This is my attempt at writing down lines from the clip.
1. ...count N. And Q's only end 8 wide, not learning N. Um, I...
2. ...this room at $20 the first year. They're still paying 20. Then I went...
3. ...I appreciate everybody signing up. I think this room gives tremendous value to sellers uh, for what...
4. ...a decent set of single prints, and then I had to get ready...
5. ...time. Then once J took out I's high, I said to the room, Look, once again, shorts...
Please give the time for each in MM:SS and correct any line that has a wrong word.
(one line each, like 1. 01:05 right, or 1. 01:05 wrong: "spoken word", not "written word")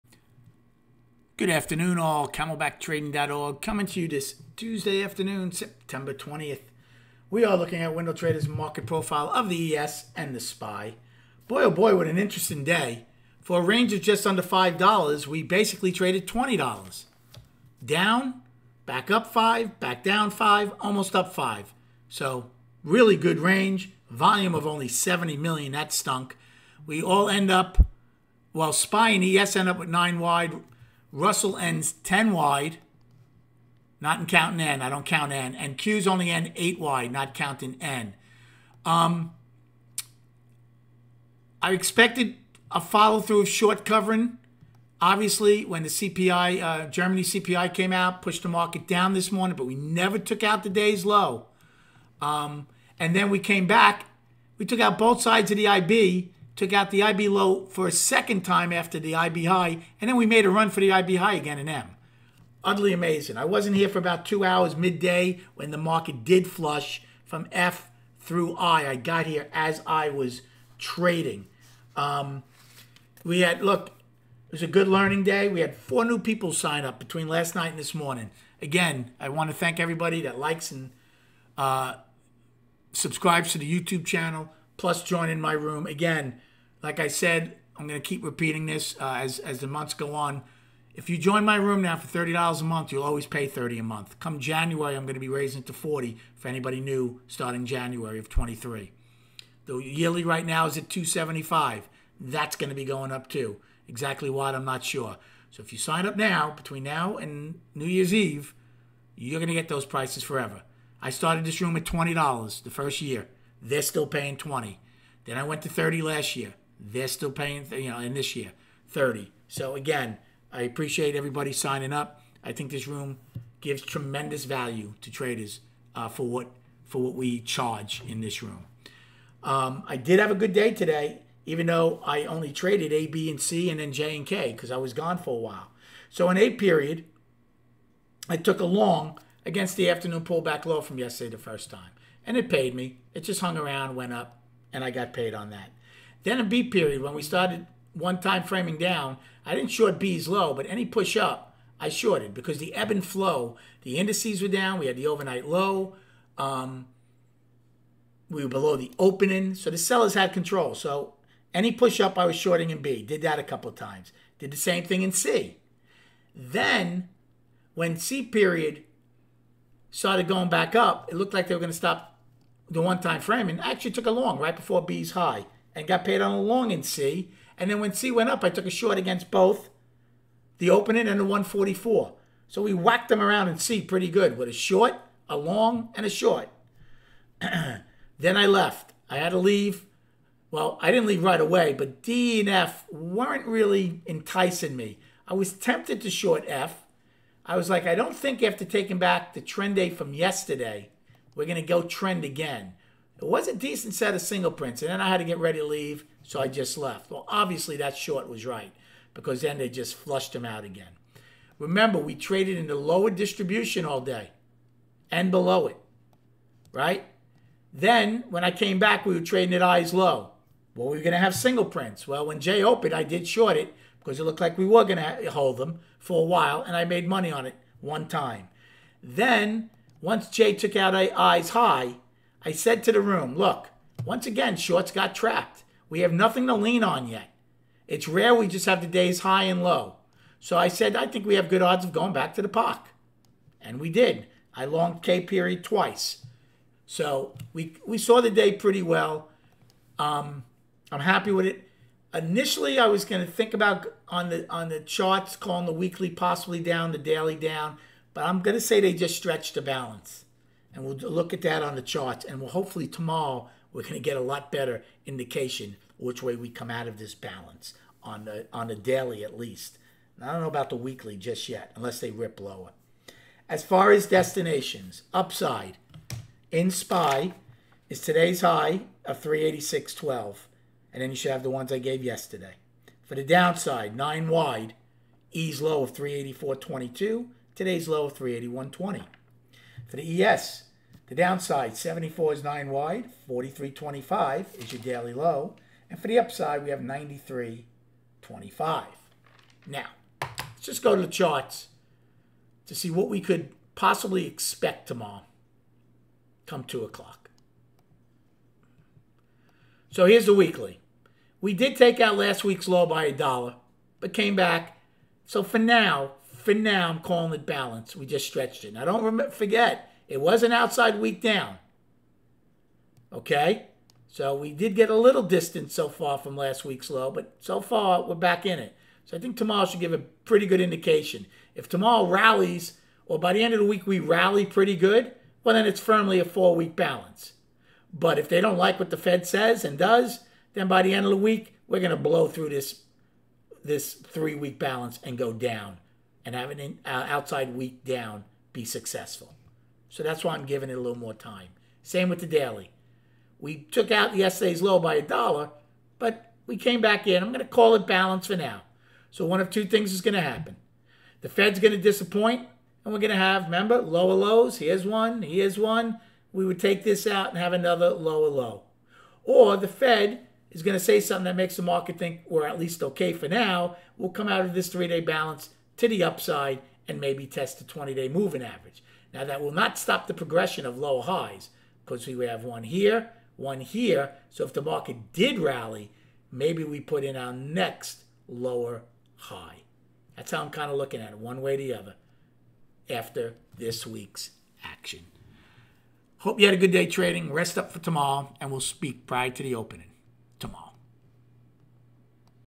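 1. 00:35 wrong: "counting", not "learning"
2. 01:51 right
3. 02:00 wrong: "traders", not "sellers"
4. 03:23 right
5. 03:48 right.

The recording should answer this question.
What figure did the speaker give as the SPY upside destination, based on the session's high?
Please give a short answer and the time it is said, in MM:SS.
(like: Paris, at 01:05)
386.12, at 04:39.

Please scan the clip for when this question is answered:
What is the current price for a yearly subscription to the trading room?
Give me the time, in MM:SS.
01:40.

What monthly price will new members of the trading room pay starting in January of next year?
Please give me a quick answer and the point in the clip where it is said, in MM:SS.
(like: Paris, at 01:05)
$40, at 01:35.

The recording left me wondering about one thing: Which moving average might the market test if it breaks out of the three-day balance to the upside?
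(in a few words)
20 day moving average.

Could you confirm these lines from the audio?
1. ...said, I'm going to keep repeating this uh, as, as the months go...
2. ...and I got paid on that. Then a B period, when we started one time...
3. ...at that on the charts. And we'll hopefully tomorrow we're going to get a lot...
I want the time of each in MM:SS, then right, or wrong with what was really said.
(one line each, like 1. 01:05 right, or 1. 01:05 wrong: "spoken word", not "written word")
1. 01:27 right
2. 02:24 right
3. 04:21 right.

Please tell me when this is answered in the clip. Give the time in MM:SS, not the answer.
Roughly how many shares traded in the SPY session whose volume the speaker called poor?
00:24.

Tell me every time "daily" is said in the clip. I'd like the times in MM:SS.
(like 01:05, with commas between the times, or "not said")
04:16, 04:28, 04:54, 05:52.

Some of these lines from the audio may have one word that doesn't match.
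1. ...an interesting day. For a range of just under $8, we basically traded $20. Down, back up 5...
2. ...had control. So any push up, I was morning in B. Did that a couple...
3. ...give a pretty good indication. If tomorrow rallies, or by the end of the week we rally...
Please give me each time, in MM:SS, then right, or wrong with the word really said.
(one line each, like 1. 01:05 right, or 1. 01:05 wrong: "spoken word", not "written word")
1. 00:12 wrong: "5", not "8"
2. 02:40 wrong: "shorting", not "morning"
3. 05:29 right.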